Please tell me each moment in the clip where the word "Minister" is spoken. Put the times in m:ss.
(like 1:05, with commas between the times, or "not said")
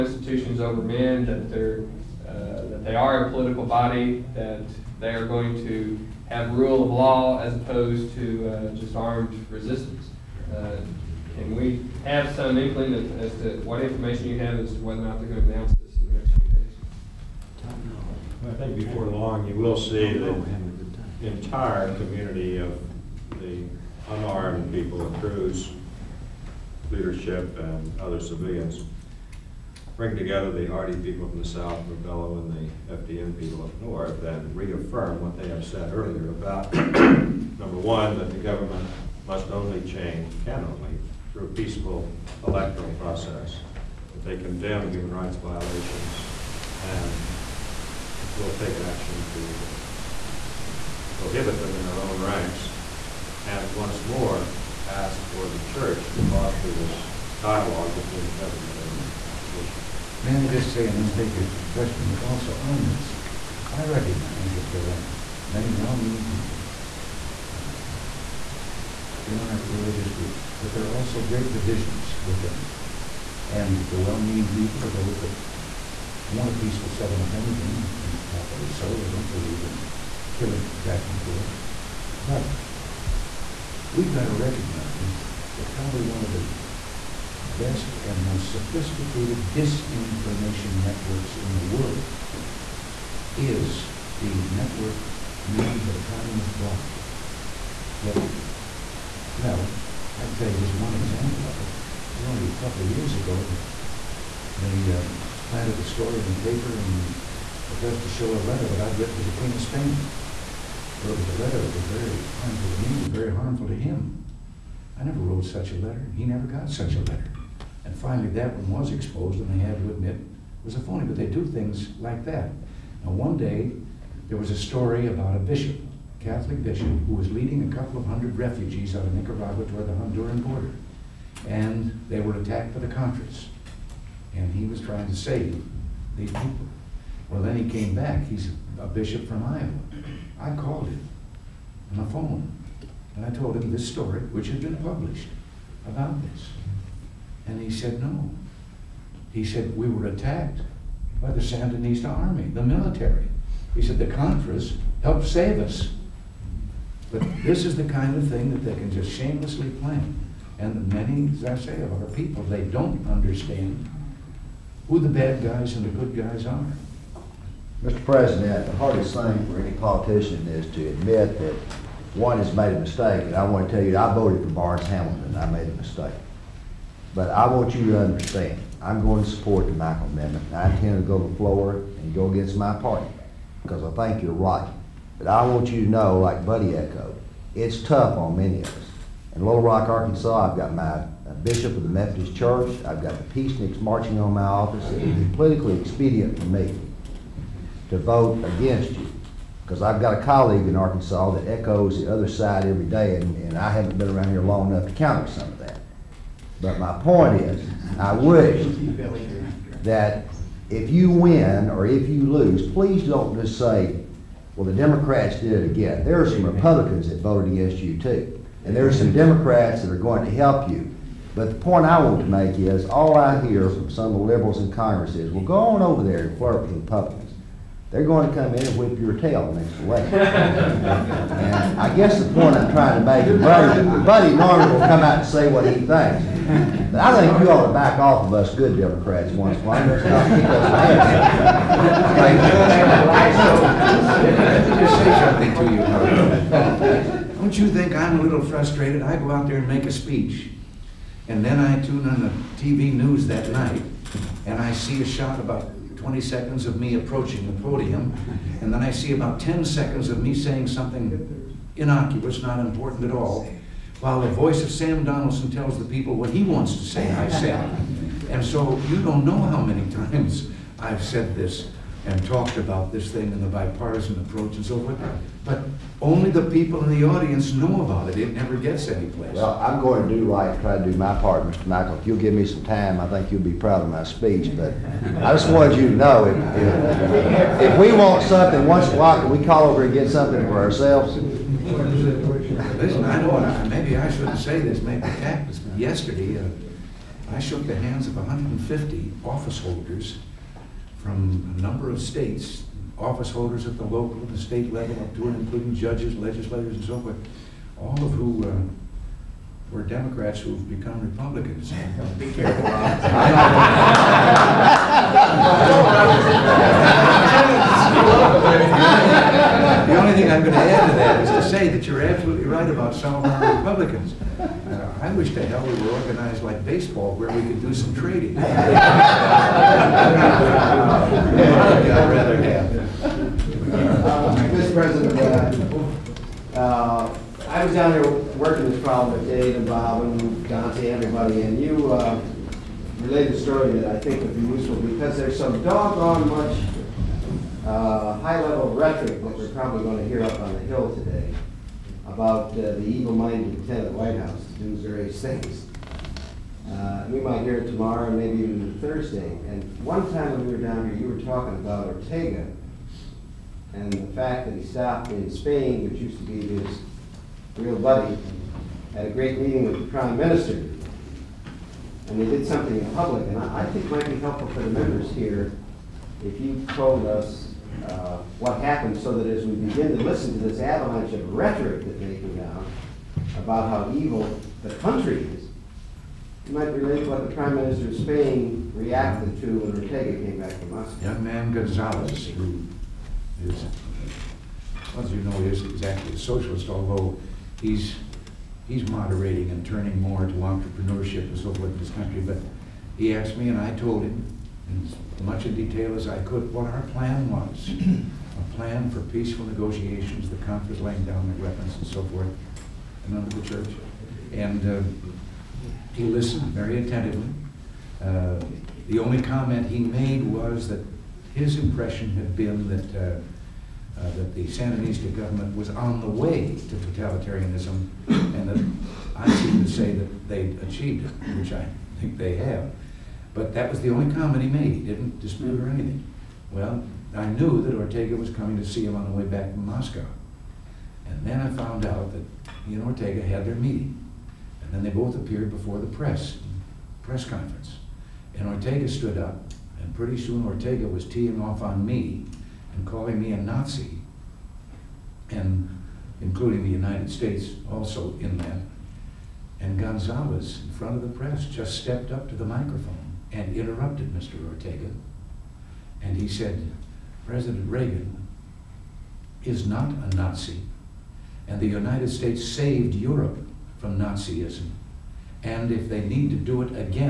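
6:10, 6:27.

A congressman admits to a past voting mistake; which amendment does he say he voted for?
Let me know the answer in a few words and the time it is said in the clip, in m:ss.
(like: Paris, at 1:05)
Barnes Hamilton, at 2:54.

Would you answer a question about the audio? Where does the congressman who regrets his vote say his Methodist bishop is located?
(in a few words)
Little Rock, Arkansas.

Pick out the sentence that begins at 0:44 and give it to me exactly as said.
That they condemn human rights violations and will take action to uh, prohibit them in their own ranks.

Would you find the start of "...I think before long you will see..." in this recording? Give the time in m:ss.
0:18.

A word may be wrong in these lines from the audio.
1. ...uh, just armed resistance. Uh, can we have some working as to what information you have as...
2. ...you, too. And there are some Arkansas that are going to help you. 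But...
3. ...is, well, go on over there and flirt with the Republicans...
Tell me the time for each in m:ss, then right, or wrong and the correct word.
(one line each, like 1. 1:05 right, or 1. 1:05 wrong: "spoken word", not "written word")
1. 0:08 wrong: "inkling", not "working"
2. 3:37 wrong: "Democrats", not "Arkansas"
3. 3:45 right.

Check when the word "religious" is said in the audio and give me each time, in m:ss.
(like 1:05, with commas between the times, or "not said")
1:09.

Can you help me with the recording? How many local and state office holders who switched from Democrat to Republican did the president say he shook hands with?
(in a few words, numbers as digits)
150.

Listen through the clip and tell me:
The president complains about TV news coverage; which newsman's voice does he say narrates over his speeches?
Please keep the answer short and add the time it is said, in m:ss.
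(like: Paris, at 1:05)
Sam Donaldson, at 4:24.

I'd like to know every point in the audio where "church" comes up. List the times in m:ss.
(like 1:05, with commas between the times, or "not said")
0:55, 3:12, 6:53.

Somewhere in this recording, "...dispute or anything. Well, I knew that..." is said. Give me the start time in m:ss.
7:15.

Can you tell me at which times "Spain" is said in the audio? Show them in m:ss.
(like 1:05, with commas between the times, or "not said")
1:49, 6:05, 6:27.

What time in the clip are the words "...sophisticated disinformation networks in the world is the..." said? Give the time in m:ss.
1:28.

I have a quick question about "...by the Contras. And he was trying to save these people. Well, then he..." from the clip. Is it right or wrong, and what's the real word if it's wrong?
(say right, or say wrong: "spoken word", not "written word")
right.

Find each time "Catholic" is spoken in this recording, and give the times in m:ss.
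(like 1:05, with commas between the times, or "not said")
2:06.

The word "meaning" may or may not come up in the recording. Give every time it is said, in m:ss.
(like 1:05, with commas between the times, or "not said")
1:05, 1:13.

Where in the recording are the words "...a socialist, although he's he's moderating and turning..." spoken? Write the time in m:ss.
6:36.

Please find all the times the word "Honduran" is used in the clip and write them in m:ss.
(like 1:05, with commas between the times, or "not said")
2:09.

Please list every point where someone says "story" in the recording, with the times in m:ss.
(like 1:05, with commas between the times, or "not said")
1:45, 2:04, 2:23, 5:43.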